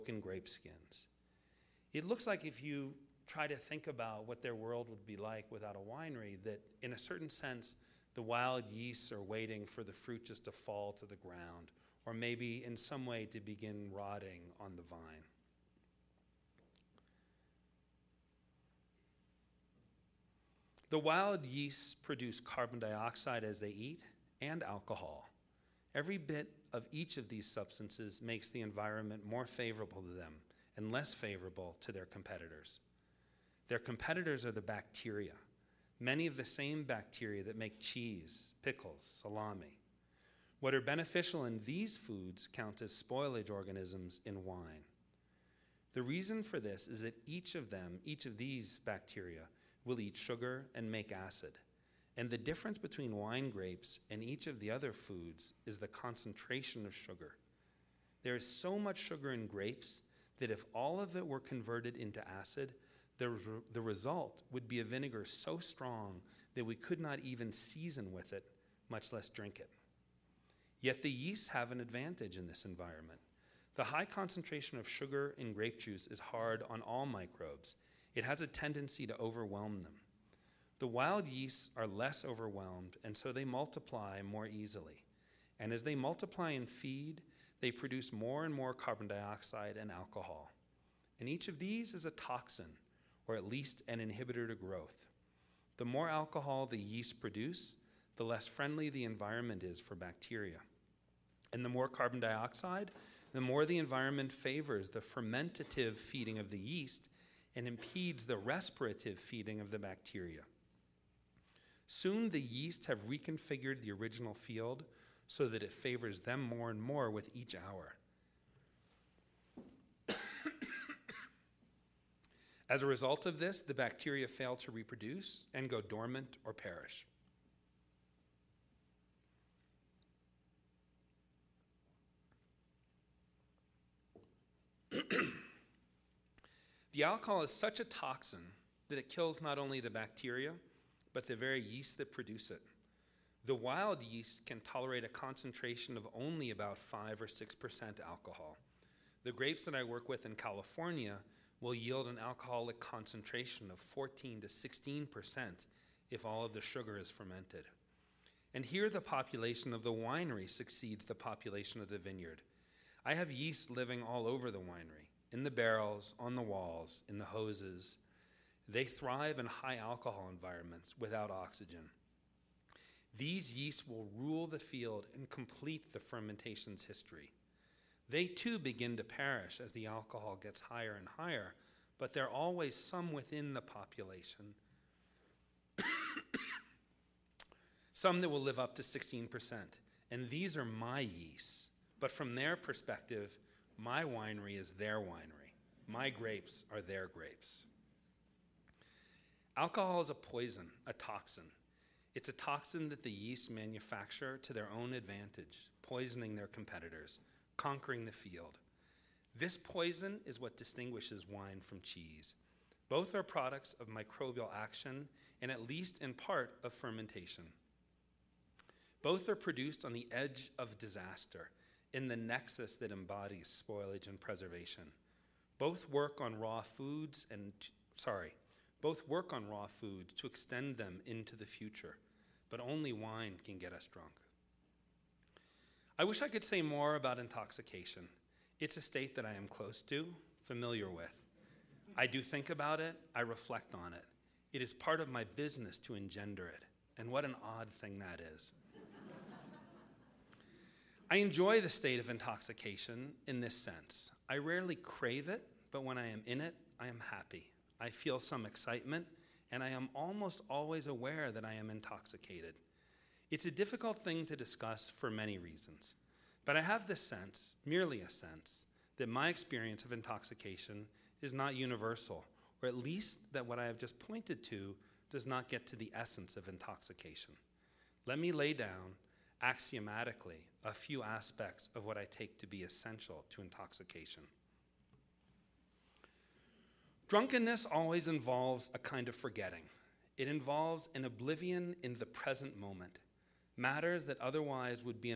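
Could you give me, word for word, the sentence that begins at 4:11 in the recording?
I enjoy the state of intoxication in this sense.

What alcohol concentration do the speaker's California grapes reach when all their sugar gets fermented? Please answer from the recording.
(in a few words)
14 to 16%.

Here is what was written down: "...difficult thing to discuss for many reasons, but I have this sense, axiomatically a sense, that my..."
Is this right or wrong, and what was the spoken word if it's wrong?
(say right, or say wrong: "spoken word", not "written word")
wrong: "merely", not "axiomatically".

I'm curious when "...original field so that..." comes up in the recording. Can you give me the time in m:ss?
1:53.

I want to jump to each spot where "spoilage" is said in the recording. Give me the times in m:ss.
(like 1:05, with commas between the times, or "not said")
0:42, 3:43.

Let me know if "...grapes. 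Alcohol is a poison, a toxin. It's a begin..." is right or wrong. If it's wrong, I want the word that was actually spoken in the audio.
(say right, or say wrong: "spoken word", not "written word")
wrong: "toxin", not "begin".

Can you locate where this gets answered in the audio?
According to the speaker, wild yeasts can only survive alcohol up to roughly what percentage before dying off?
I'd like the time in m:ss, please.
2:26.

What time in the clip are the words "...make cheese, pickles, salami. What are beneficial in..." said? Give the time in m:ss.
0:37.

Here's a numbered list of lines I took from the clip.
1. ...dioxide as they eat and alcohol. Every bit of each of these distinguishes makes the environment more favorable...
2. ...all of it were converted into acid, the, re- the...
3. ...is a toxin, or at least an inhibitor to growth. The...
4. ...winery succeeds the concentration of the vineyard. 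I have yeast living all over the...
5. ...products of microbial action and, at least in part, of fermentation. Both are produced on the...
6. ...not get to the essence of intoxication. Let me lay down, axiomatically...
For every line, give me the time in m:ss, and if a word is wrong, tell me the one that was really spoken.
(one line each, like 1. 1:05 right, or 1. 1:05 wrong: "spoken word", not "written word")
1. 0:22 wrong: "substances", not "distinguishes"
2. 1:00 right
3. 1:31 right
4. 2:39 wrong: "population", not "concentration"
5. 3:33 right
6. 4:35 right.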